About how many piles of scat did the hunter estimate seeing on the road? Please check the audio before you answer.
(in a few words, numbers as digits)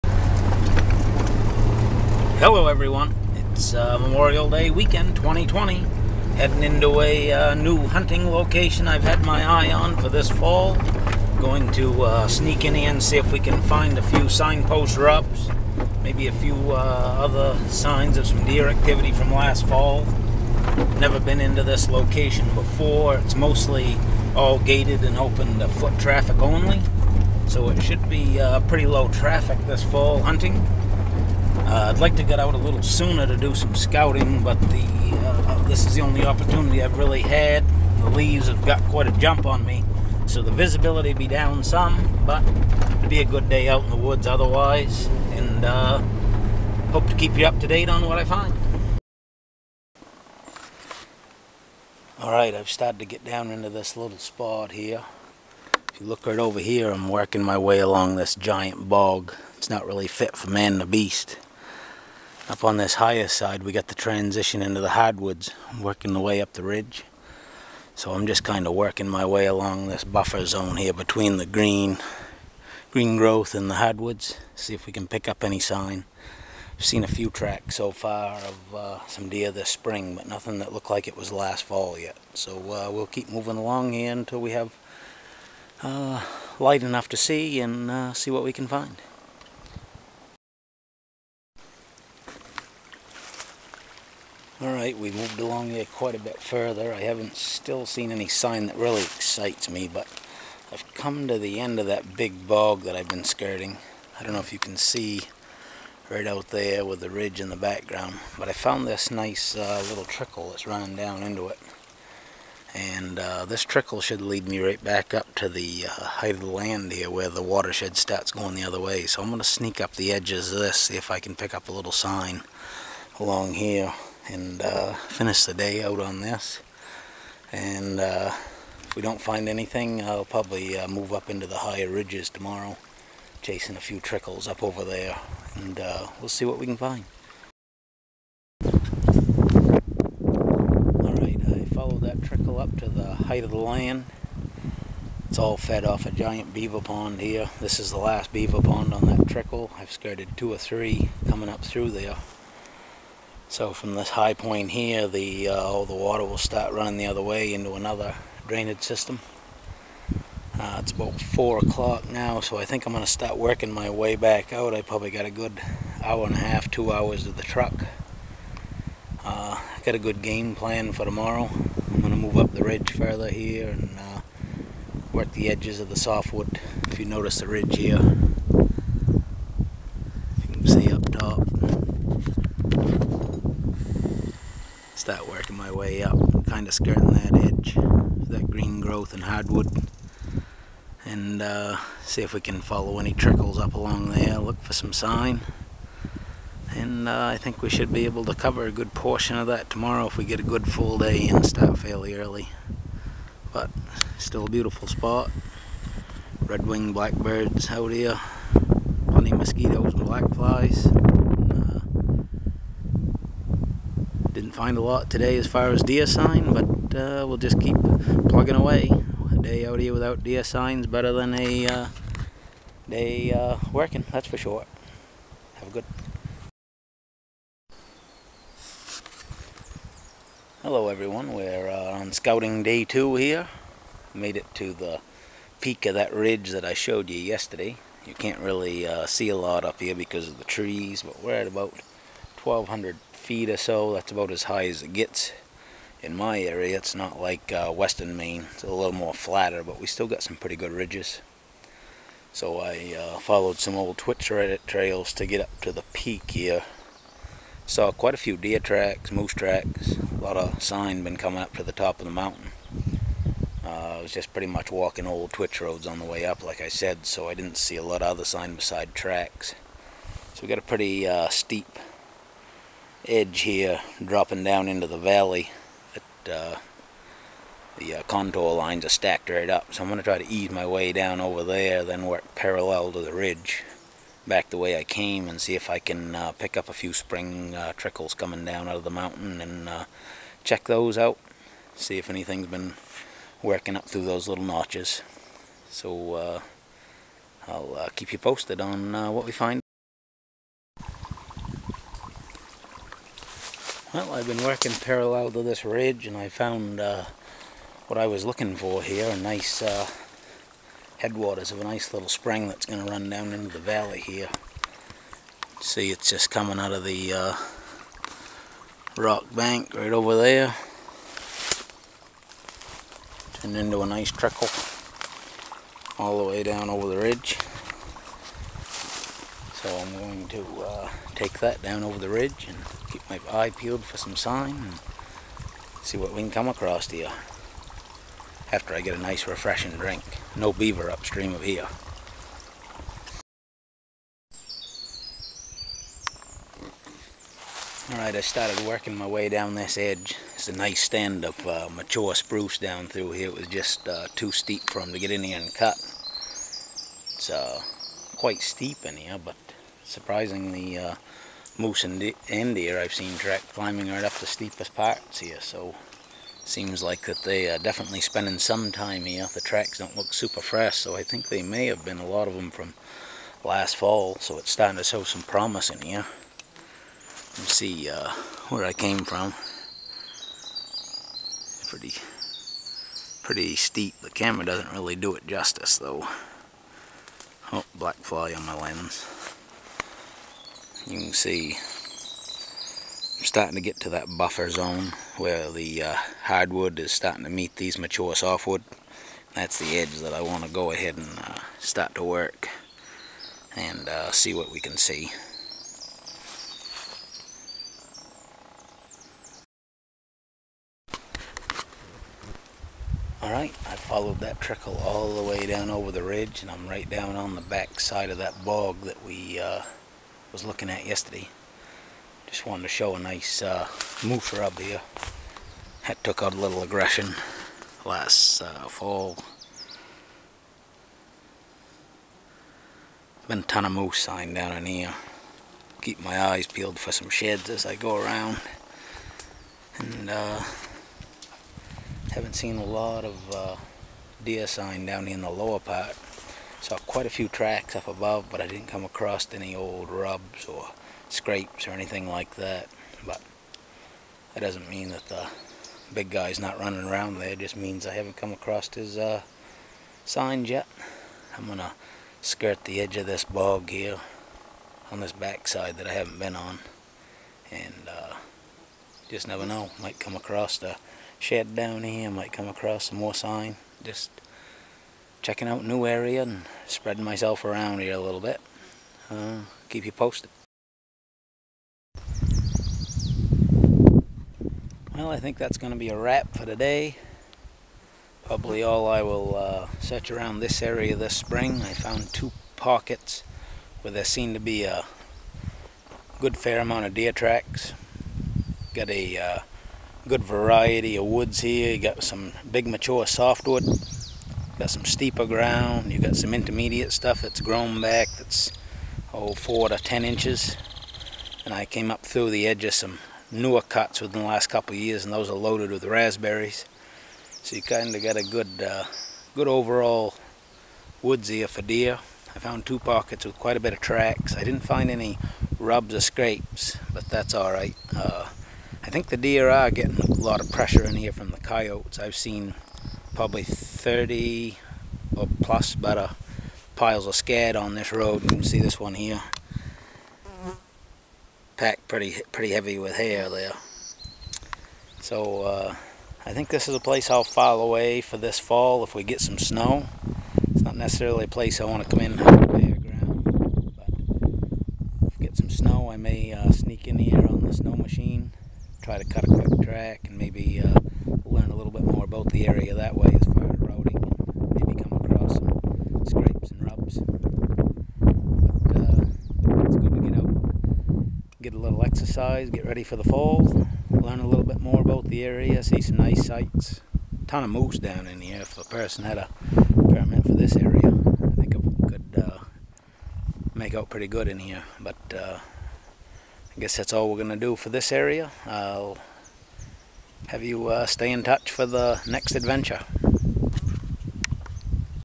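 30.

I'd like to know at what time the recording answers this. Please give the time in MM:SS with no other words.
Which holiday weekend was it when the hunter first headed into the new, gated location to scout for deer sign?
00:03.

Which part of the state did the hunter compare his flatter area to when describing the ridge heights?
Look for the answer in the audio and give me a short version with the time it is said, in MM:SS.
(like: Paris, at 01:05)
western Maine, at 04:07.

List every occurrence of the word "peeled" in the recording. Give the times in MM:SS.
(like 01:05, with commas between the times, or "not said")
05:33, 07:16.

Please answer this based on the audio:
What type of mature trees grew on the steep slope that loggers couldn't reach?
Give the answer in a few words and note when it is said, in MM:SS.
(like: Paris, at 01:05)
spruce, at 05:52.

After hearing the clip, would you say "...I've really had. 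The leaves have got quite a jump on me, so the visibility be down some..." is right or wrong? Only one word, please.
right.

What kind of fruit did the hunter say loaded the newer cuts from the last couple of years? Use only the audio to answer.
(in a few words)
raspberries.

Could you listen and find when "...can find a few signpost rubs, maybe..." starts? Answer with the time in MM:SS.
00:13.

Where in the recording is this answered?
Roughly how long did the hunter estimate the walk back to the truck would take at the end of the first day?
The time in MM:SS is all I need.
02:46.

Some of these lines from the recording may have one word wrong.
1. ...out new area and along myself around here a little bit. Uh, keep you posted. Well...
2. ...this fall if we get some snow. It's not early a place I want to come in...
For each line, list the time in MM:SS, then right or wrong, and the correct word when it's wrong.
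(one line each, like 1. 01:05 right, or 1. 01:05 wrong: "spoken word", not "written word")
1. 07:55 wrong: "spreading", not "along"
2. 09:08 wrong: "necessarily", not "early".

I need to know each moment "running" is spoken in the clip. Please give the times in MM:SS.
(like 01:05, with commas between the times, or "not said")
01:50, 02:36, 07:36.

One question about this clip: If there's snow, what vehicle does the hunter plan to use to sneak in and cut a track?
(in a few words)
snow machine.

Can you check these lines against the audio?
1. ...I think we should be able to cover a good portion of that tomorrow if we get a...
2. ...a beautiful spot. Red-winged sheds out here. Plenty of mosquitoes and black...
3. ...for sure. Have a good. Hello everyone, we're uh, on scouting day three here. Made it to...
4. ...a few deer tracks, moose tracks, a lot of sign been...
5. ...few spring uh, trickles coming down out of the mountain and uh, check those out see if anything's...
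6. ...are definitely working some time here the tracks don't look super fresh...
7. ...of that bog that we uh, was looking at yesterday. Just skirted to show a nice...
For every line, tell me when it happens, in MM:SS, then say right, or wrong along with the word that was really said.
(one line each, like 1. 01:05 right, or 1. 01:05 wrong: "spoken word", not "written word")
1. 03:17 right
2. 03:24 wrong: "blackbirds", not "sheds"
3. 03:44 wrong: "two", not "three"
4. 04:18 right
5. 04:46 right
6. 06:07 wrong: "spending", not "working"
7. 06:58 wrong: "wanted", not "skirted".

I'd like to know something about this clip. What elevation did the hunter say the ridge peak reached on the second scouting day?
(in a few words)
1200 feet.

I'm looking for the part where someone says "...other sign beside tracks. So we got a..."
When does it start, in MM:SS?
04:28.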